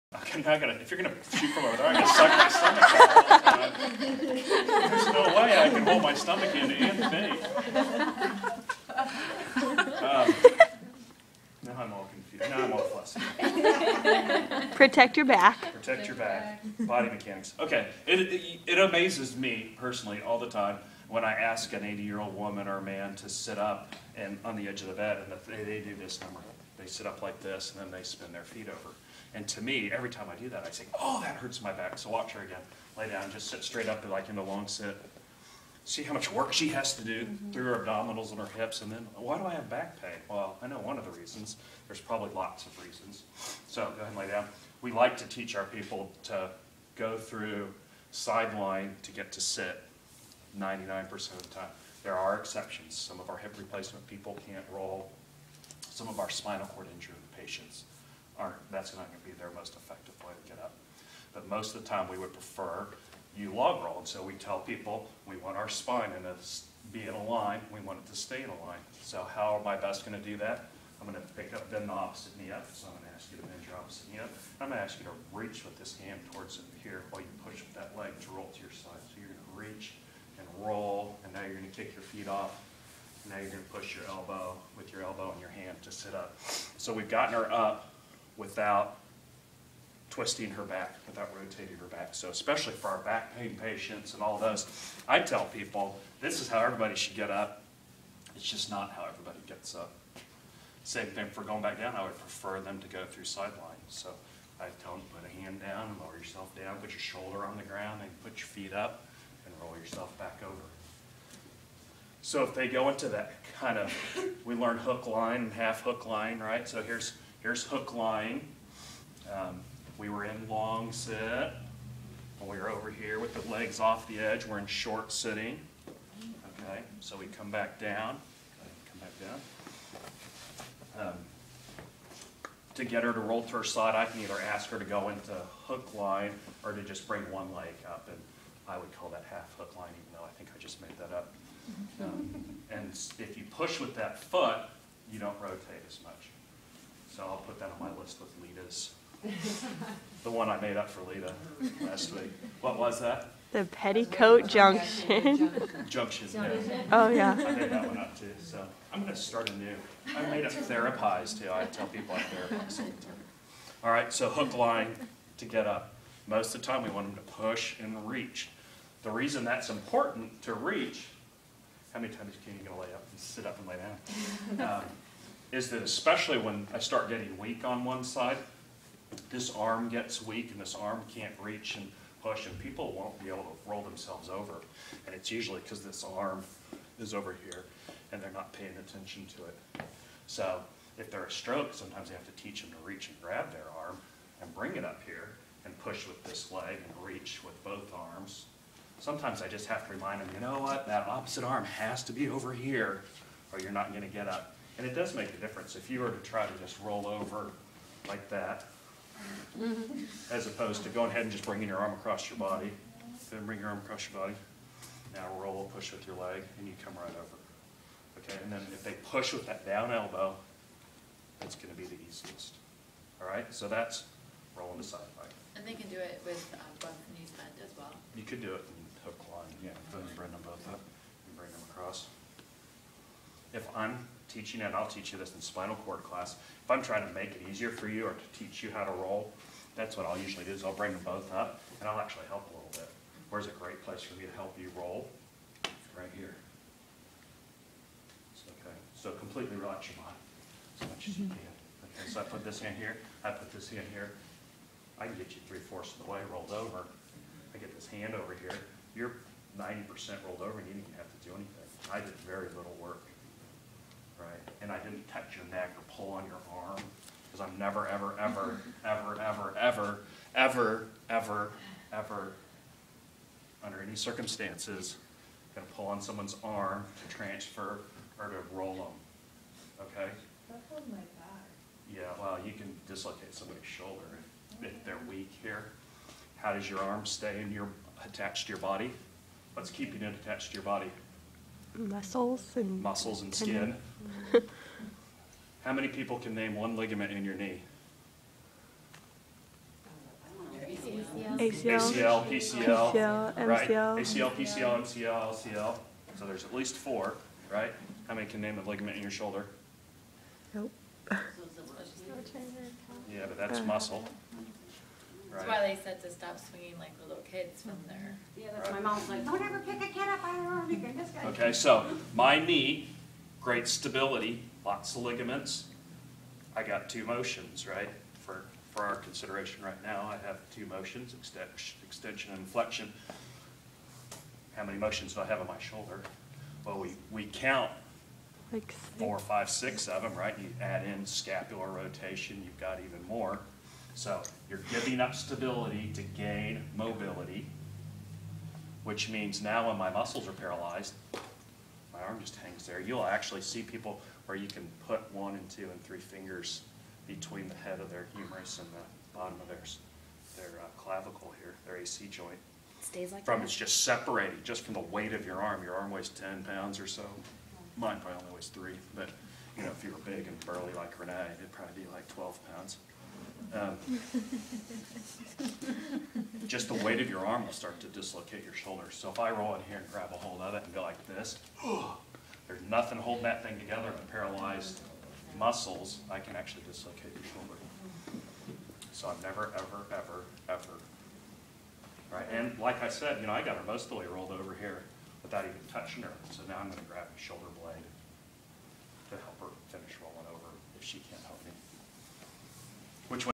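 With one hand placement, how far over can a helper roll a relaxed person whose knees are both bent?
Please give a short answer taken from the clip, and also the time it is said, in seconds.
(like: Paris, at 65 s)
three-fourths, at 255 s.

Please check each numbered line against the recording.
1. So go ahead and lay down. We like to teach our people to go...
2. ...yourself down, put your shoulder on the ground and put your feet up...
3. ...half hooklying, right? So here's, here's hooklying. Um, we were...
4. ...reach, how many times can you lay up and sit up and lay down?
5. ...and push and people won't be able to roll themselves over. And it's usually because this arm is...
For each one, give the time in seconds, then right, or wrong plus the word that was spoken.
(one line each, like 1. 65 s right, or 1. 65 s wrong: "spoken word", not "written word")
1. 43 s right
2. 106 s right
3. 115 s right
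4. 170 s right
5. 181 s right.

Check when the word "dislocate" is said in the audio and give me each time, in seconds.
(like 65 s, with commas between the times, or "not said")
282 s, 377 s, 386 s.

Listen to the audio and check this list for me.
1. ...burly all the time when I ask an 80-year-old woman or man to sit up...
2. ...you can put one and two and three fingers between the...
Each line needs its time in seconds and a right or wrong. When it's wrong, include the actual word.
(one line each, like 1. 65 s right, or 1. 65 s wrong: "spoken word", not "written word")
1. 19 s wrong: "personally", not "burly"
2. 354 s right.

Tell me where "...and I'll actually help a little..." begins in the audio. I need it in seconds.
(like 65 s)
241 s.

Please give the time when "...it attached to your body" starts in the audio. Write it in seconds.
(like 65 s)
290 s.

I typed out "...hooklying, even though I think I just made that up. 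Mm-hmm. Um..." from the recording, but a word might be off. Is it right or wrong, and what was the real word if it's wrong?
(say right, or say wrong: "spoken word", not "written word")
right.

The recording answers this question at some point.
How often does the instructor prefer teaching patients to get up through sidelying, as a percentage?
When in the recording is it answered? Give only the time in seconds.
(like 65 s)
50 s.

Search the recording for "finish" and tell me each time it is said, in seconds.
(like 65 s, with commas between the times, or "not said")
399 s.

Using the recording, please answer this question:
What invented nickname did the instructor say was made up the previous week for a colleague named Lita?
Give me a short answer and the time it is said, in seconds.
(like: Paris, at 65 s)
The Petticoat Junction, at 153 s.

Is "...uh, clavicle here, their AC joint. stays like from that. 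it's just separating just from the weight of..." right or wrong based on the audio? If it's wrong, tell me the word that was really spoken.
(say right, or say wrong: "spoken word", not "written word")
right.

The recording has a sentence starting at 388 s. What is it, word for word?
So I'm never, ever, ever, ever.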